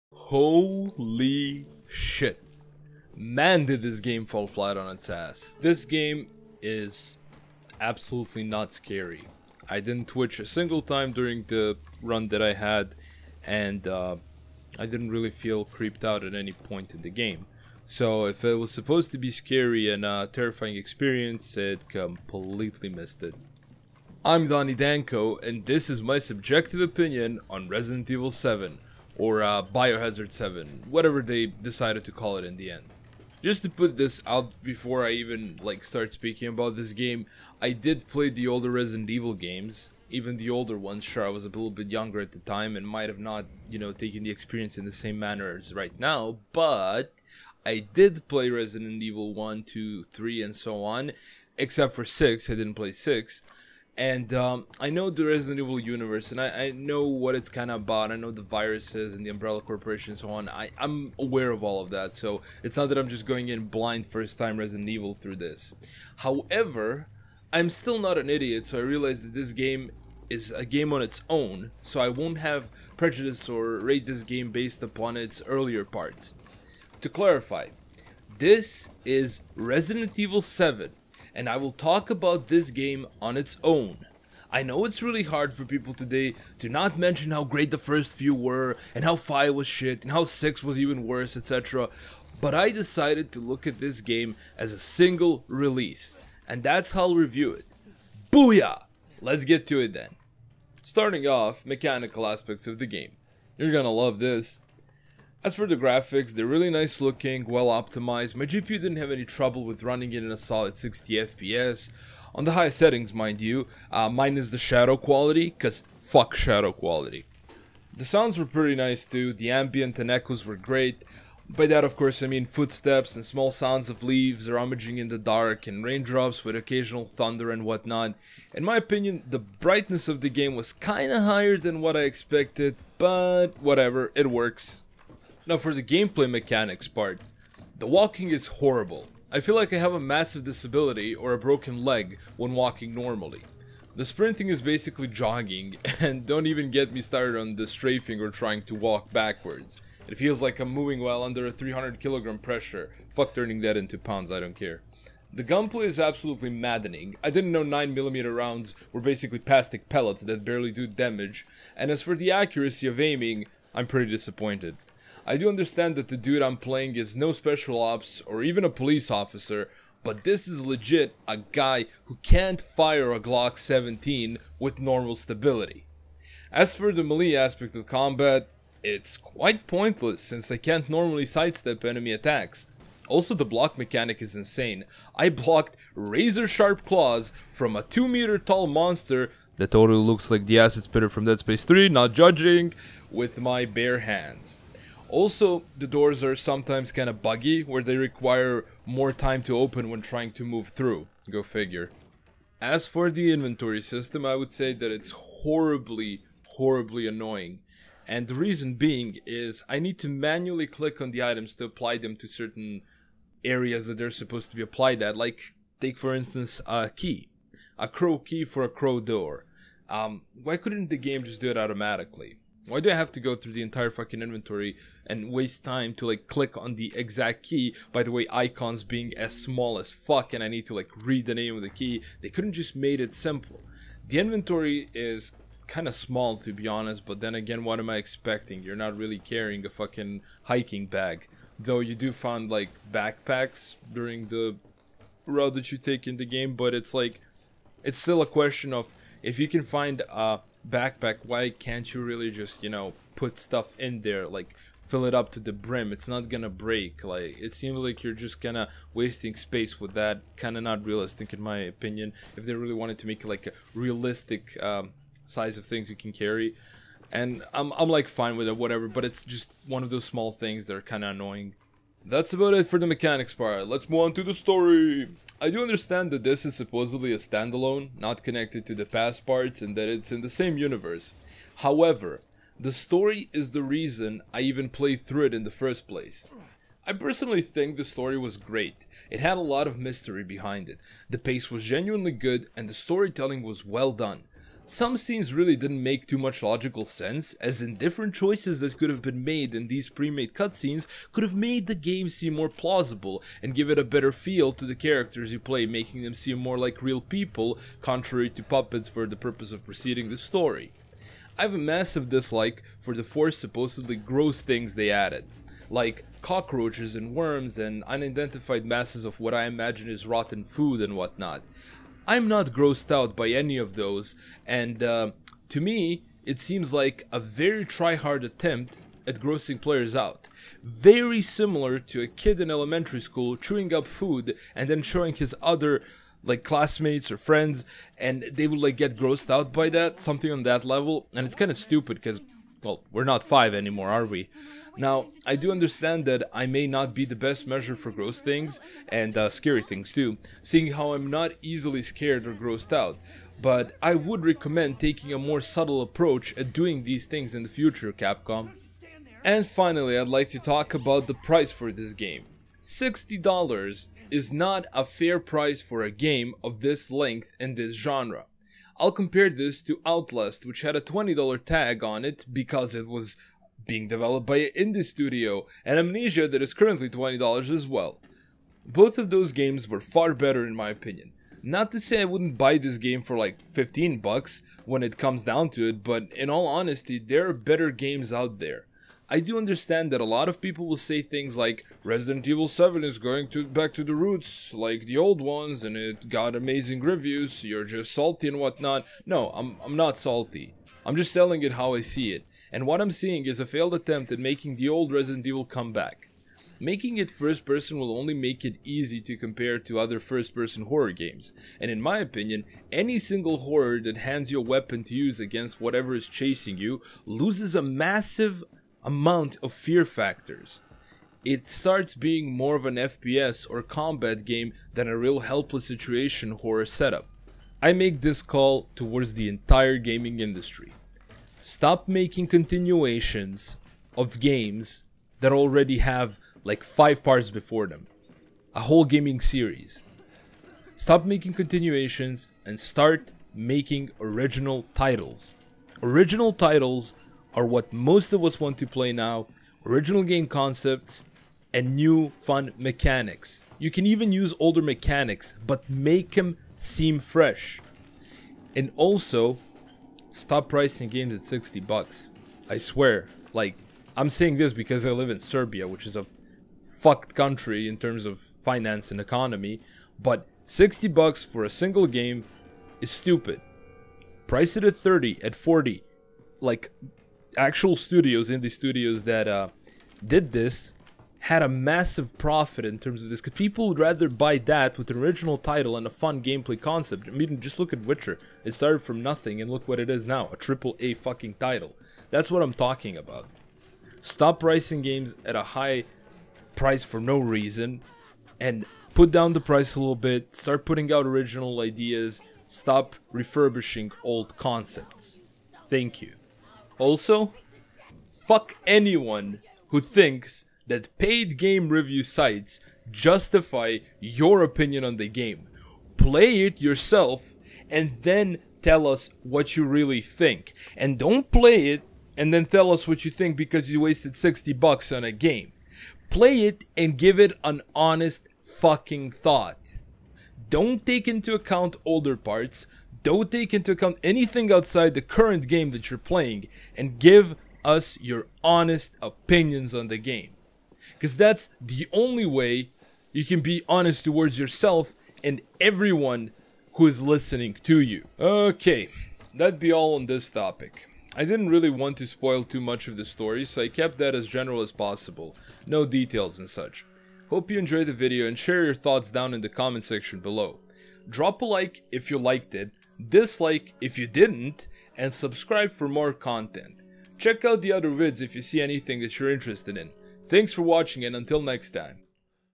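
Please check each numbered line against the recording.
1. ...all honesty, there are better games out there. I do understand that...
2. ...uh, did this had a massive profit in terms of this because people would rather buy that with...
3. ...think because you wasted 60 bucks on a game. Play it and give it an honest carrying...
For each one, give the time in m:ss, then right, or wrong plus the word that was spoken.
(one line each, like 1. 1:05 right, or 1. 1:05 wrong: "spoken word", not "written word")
1. 6:26 right
2. 7:59 right
3. 8:43 wrong: "fucking", not "carrying".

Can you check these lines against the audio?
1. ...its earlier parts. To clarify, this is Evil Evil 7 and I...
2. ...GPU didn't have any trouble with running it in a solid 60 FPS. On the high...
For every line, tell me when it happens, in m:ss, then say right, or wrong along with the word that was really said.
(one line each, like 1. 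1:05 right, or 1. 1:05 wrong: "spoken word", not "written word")
1. 1:15 wrong: "Resident", not "Evil"
2. 1:48 right.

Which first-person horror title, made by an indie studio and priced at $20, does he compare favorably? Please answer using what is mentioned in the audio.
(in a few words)
Outlast.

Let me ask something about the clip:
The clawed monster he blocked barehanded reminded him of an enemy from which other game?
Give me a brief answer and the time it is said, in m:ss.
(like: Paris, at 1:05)
Dead Space 3, at 3:11.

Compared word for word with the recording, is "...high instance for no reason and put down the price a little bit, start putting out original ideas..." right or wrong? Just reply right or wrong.
wrong.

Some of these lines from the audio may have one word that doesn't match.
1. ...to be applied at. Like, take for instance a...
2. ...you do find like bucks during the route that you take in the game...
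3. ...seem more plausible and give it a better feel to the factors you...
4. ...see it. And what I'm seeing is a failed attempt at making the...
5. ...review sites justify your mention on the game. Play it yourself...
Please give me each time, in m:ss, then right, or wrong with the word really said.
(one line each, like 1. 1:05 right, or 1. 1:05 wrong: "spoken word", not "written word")
1. 3:34 right
2. 4:01 wrong: "backpacks", not "bucks"
3. 5:02 wrong: "characters", not "factors"
4. 6:41 right
5. 8:31 wrong: "opinion", not "mention".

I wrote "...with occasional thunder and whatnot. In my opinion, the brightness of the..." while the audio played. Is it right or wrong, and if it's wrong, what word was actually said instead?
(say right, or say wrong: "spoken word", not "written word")
right.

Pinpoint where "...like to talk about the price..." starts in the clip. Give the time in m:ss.
6:00.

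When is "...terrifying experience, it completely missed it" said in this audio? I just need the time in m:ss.
0:20.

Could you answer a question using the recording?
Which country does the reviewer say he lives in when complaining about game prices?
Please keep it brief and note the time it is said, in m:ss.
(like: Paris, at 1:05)
Serbia, at 7:45.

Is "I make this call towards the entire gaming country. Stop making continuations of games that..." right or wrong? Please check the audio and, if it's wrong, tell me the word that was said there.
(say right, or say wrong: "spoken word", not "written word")
wrong: "industry", not "country".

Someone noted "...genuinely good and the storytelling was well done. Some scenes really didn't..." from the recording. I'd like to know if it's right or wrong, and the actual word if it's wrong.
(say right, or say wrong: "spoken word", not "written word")
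right.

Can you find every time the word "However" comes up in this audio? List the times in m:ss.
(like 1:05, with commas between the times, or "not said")
1:06, 4:41.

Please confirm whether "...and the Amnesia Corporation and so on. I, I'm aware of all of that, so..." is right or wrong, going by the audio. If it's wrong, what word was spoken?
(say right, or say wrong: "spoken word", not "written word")
wrong: "Umbrella", not "Amnesia".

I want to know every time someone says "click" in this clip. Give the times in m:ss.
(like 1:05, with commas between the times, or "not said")
3:30, 3:46.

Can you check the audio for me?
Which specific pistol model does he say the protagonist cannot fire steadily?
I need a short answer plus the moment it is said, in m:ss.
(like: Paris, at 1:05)
Glock 17, at 2:53.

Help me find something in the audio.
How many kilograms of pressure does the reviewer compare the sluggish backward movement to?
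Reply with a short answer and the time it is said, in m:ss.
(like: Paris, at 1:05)
300, at 2:31.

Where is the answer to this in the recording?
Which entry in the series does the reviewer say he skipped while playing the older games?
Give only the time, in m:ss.
0:51.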